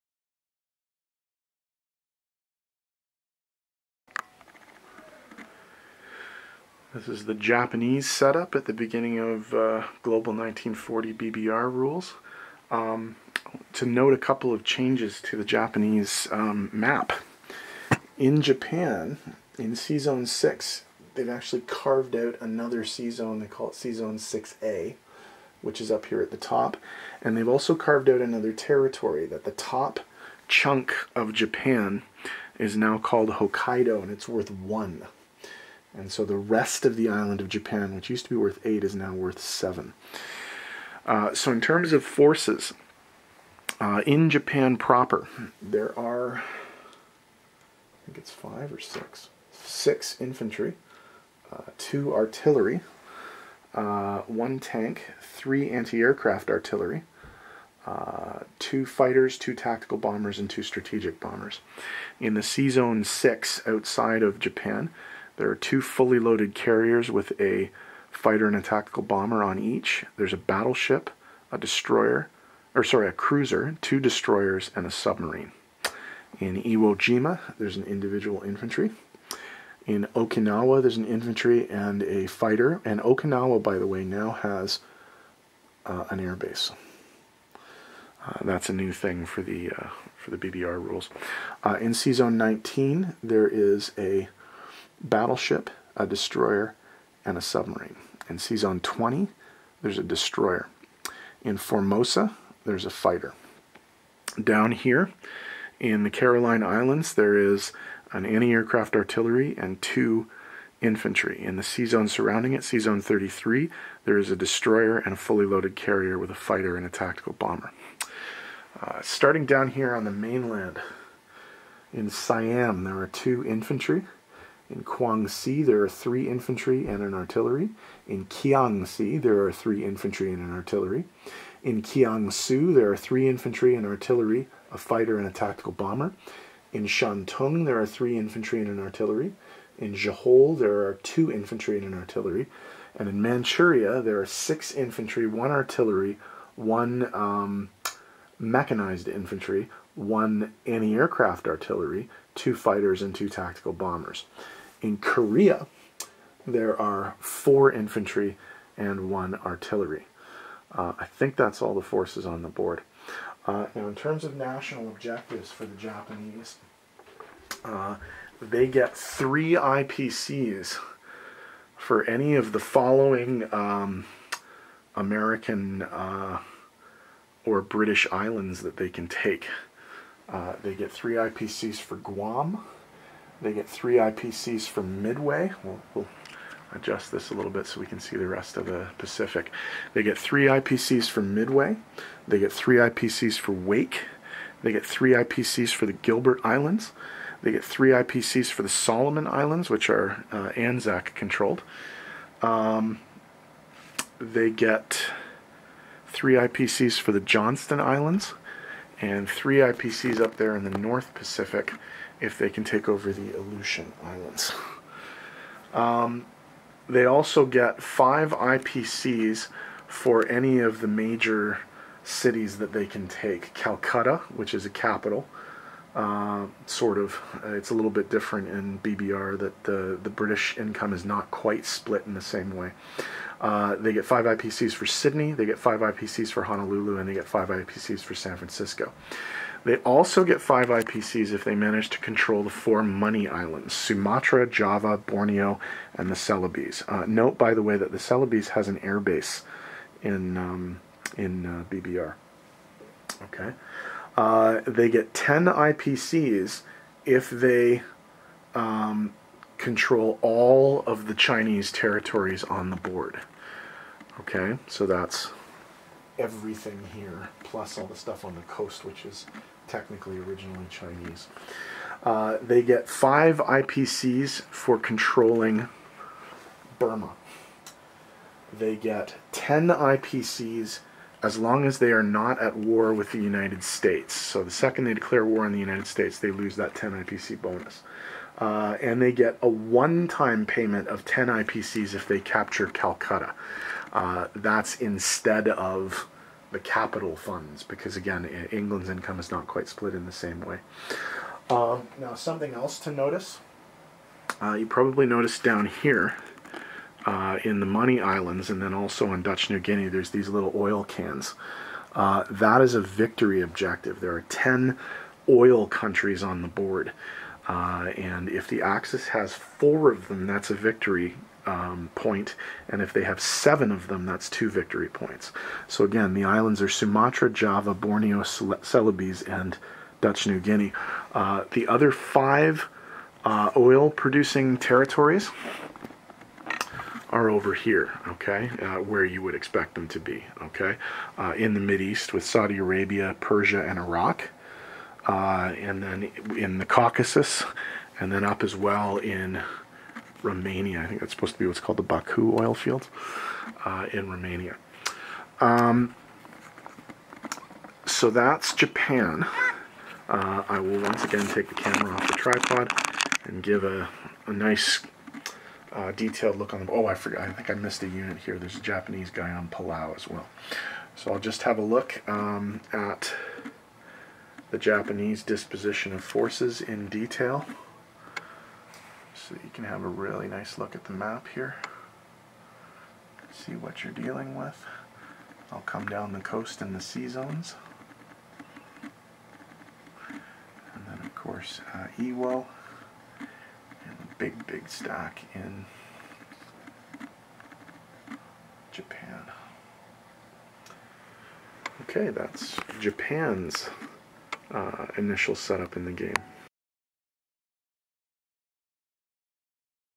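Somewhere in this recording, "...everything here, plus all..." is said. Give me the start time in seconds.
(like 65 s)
266 s.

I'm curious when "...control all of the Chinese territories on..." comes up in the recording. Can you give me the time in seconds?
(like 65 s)
259 s.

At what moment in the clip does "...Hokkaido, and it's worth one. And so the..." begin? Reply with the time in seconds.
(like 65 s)
33 s.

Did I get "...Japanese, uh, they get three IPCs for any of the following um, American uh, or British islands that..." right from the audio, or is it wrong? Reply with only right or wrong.
right.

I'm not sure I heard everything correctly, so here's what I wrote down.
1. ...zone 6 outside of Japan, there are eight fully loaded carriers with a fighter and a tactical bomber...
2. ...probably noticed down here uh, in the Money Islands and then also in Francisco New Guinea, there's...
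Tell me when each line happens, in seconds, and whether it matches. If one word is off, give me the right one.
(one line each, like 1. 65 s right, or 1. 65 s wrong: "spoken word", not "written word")
1. 62 s wrong: "two", not "eight"
2. 304 s wrong: "Dutch", not "Francisco".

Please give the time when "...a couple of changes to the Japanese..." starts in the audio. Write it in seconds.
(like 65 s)
14 s.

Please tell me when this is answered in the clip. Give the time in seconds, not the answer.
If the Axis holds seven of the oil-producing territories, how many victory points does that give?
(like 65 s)
324 s.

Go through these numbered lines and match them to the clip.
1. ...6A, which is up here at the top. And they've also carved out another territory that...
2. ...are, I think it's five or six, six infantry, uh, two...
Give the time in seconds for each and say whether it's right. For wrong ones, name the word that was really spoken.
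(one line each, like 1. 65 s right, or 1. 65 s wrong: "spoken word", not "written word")
1. 24 s right
2. 45 s right.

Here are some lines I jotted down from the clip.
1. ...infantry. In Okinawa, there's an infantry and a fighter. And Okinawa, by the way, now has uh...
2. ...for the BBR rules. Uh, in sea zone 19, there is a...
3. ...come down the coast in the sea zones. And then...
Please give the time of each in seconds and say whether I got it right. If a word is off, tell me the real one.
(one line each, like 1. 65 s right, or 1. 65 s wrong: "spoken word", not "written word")
1. 78 s right
2. 90 s right
3. 385 s right.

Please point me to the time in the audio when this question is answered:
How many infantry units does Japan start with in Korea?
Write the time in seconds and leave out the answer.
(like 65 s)
157 s.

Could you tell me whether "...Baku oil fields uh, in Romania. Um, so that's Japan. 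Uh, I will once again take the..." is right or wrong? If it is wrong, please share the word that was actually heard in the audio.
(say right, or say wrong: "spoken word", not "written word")
right.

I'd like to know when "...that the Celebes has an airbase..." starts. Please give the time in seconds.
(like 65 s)
247 s.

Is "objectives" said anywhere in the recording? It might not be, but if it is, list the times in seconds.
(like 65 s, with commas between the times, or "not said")
164 s, 313 s.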